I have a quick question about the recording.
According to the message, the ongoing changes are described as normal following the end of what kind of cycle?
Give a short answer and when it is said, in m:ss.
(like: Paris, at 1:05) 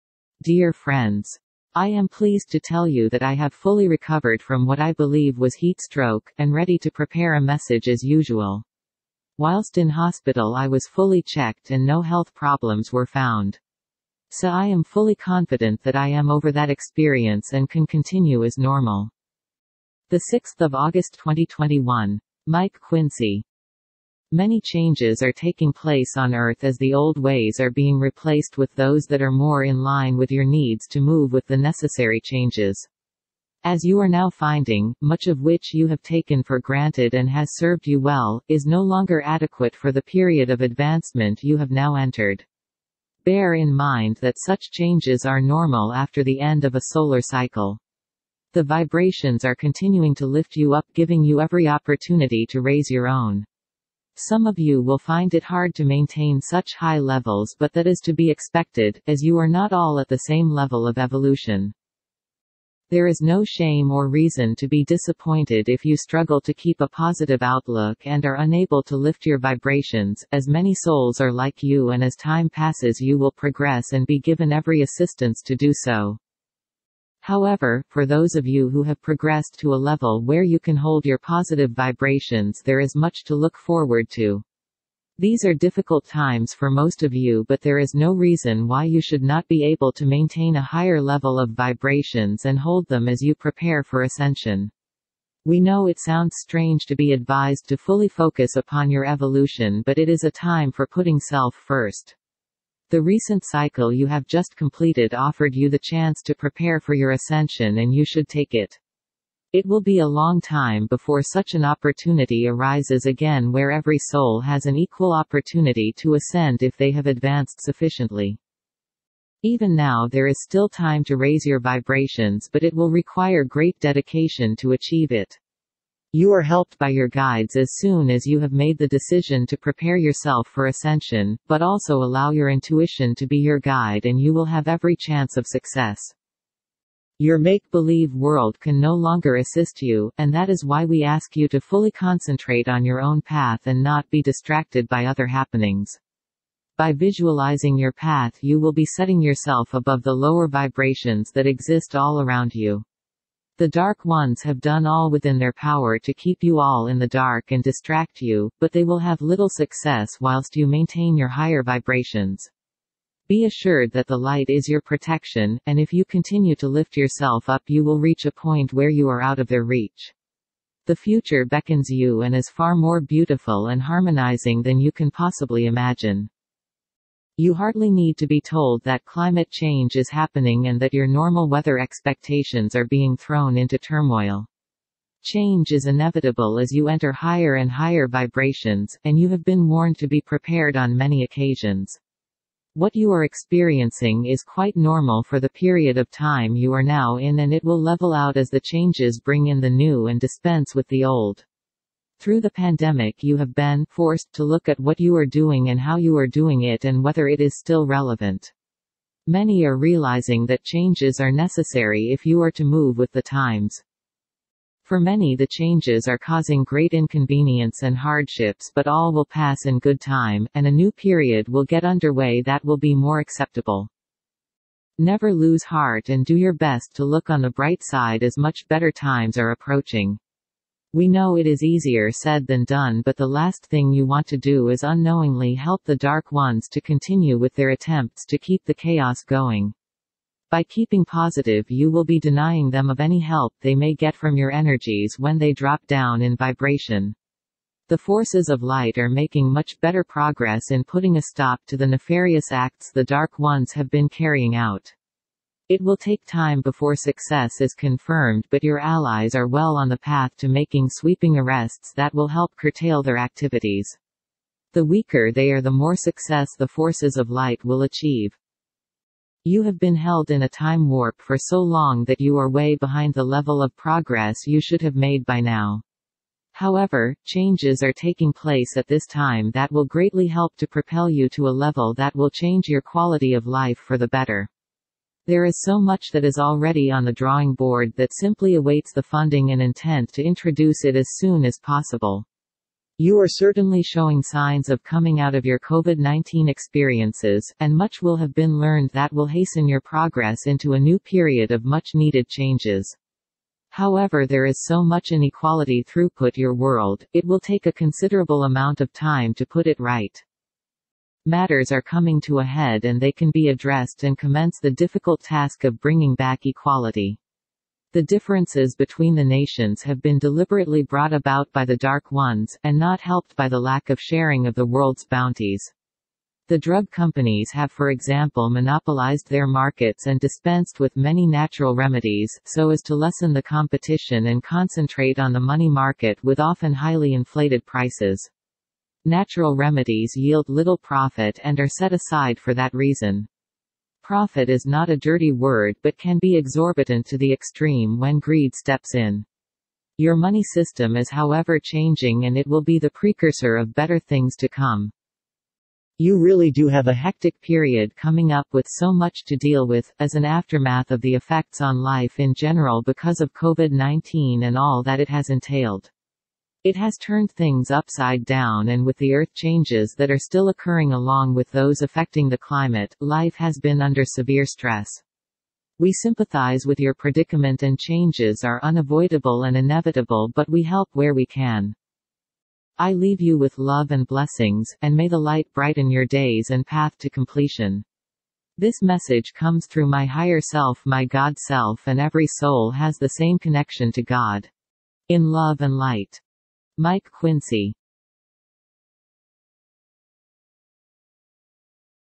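solar cycle, at 0:46.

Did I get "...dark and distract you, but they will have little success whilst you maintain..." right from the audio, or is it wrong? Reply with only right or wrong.
right.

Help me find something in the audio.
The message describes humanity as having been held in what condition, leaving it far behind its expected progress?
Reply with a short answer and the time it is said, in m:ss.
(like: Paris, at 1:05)
a time warp, at 4:30.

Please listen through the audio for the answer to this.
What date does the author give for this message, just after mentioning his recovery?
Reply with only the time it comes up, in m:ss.
0:20.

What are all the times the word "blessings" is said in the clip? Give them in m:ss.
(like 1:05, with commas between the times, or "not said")
6:24.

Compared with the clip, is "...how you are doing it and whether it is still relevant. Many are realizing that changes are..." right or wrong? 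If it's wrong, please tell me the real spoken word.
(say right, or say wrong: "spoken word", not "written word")
right.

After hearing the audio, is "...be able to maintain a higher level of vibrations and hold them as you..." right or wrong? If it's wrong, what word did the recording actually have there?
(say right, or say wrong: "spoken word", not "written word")
right.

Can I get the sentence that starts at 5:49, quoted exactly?
Your money system is however changing and it will be the precursor of better things to come.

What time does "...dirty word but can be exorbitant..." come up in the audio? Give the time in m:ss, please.
5:44.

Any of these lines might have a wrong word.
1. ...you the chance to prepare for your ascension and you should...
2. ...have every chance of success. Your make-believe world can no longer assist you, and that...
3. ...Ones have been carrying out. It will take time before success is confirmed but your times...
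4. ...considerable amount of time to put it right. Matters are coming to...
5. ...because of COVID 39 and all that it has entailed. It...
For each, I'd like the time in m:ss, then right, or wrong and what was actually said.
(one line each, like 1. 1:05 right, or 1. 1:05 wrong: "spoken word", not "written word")
1. 1:45 right
2. 2:14 right
3. 4:13 wrong: "allies", not "times"
4. 5:07 right
5. 6:02 wrong: "19", not "39".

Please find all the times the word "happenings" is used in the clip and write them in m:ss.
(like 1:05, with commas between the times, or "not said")
2:25, 3:00.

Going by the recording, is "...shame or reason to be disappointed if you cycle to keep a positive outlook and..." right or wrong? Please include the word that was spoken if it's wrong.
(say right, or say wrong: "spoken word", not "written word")
wrong: "struggle", not "cycle".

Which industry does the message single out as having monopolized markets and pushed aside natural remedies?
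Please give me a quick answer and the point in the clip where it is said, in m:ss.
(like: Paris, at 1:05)
drug companies, at 5:26.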